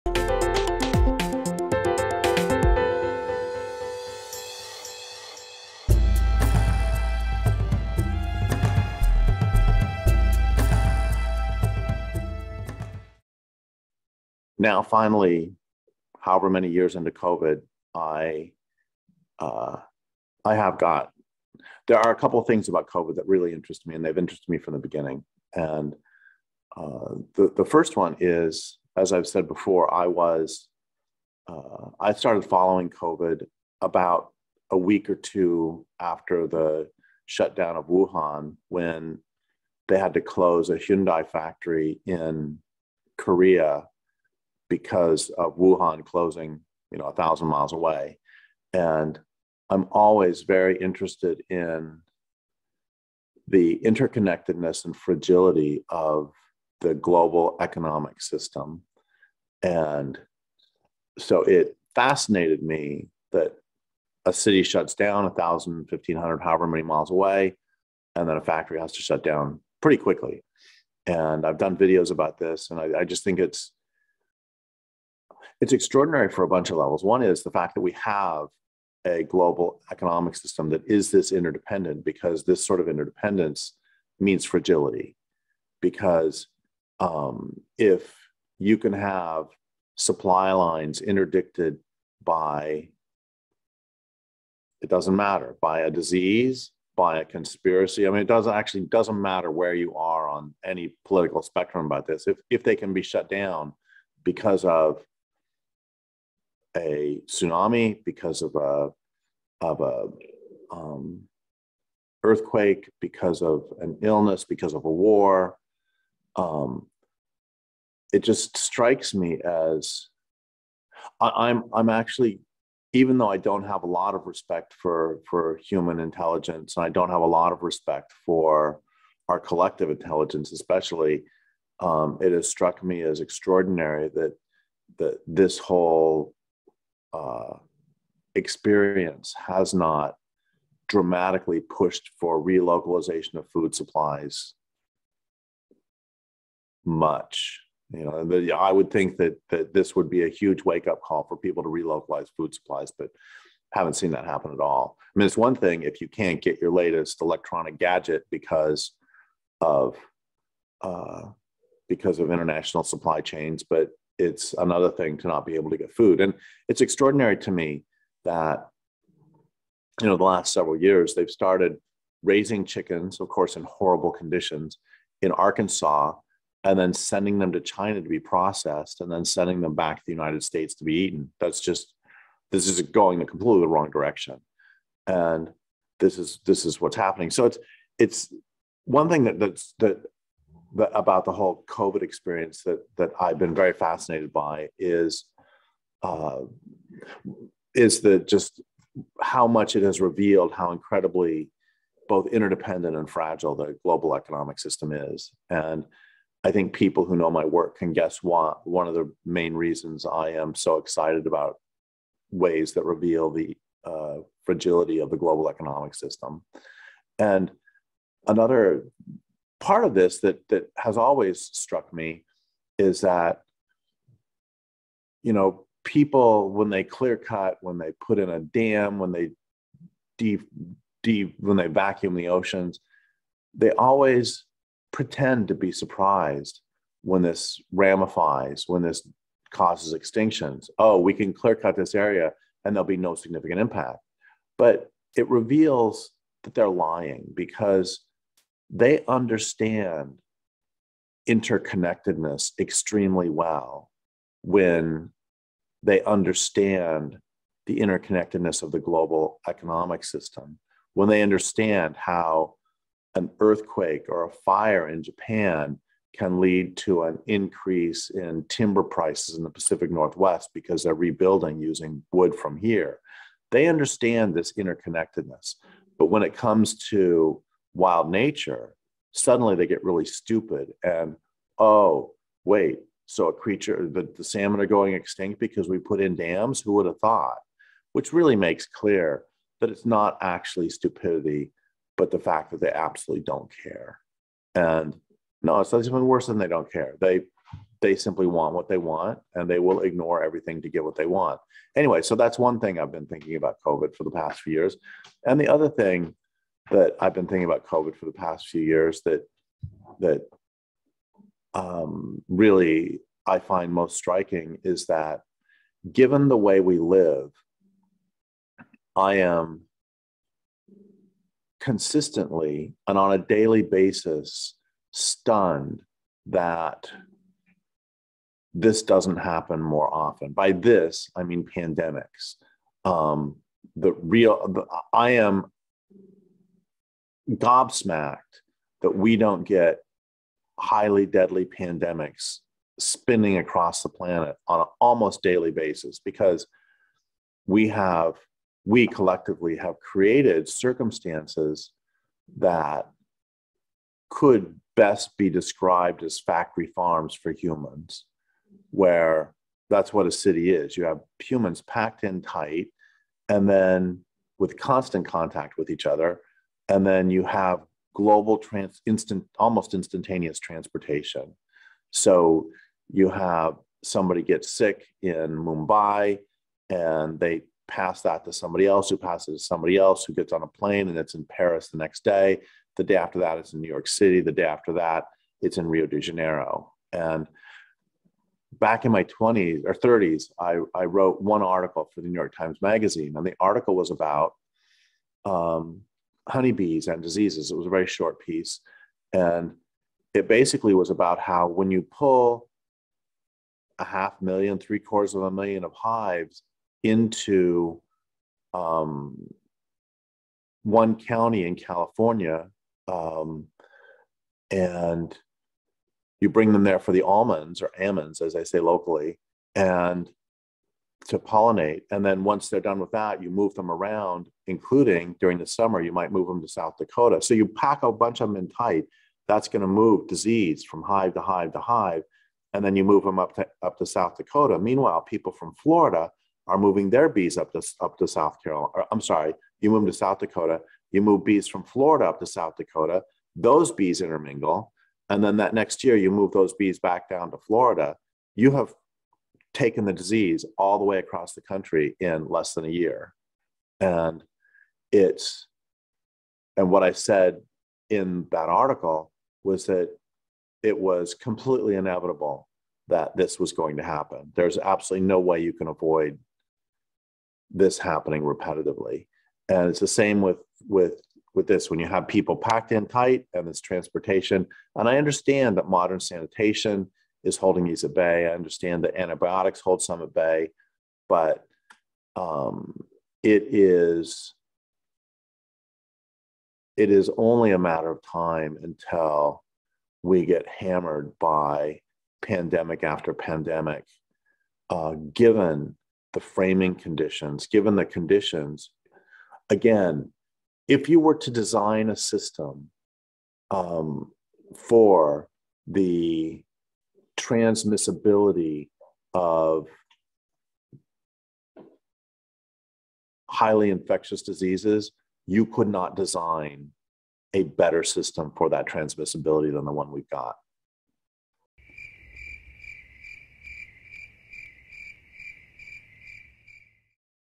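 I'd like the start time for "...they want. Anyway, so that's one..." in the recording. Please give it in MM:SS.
05:00.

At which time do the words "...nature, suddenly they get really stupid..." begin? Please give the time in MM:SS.
04:38.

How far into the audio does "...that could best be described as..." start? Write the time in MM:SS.
05:52.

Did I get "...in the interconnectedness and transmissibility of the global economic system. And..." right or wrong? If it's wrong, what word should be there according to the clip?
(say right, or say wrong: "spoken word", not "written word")
wrong: "fragility", not "transmissibility".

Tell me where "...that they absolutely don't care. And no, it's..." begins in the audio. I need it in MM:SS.
04:52.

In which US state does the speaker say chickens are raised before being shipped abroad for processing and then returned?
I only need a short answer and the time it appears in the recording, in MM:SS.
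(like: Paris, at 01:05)
Arkansas, at 02:55.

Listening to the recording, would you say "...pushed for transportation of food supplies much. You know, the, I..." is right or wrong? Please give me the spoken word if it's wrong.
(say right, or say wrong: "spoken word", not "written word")
wrong: "relocalization", not "transportation".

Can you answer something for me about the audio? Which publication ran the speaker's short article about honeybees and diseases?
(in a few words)
New York Times Magazine.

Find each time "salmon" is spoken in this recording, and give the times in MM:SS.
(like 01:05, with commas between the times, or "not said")
04:44.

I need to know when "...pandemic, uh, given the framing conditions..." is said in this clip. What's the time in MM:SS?
08:13.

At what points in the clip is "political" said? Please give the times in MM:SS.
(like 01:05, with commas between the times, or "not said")
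01:41.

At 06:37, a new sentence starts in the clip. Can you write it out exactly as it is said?
It was a very short piece.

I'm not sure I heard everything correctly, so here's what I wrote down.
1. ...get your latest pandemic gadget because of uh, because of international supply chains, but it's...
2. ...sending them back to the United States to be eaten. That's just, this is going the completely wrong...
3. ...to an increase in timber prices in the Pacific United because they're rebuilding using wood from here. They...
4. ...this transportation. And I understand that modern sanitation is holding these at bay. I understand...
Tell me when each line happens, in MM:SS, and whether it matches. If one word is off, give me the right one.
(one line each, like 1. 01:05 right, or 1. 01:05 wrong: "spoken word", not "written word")
1. 02:36 wrong: "electronic", not "pandemic"
2. 02:59 right
3. 04:26 wrong: "Northwest", not "United"
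4. 07:53 right.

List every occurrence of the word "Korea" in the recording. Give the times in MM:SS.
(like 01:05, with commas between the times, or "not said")
00:43.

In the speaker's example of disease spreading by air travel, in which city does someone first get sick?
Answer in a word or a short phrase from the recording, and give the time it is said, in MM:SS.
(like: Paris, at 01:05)
Mumbai, at 06:15.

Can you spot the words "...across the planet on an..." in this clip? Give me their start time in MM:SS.
05:43.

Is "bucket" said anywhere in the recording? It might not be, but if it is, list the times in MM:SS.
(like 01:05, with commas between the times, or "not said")
not said.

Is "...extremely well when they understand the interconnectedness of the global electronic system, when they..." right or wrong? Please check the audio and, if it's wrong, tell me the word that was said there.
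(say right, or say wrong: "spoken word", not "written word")
wrong: "economic", not "electronic".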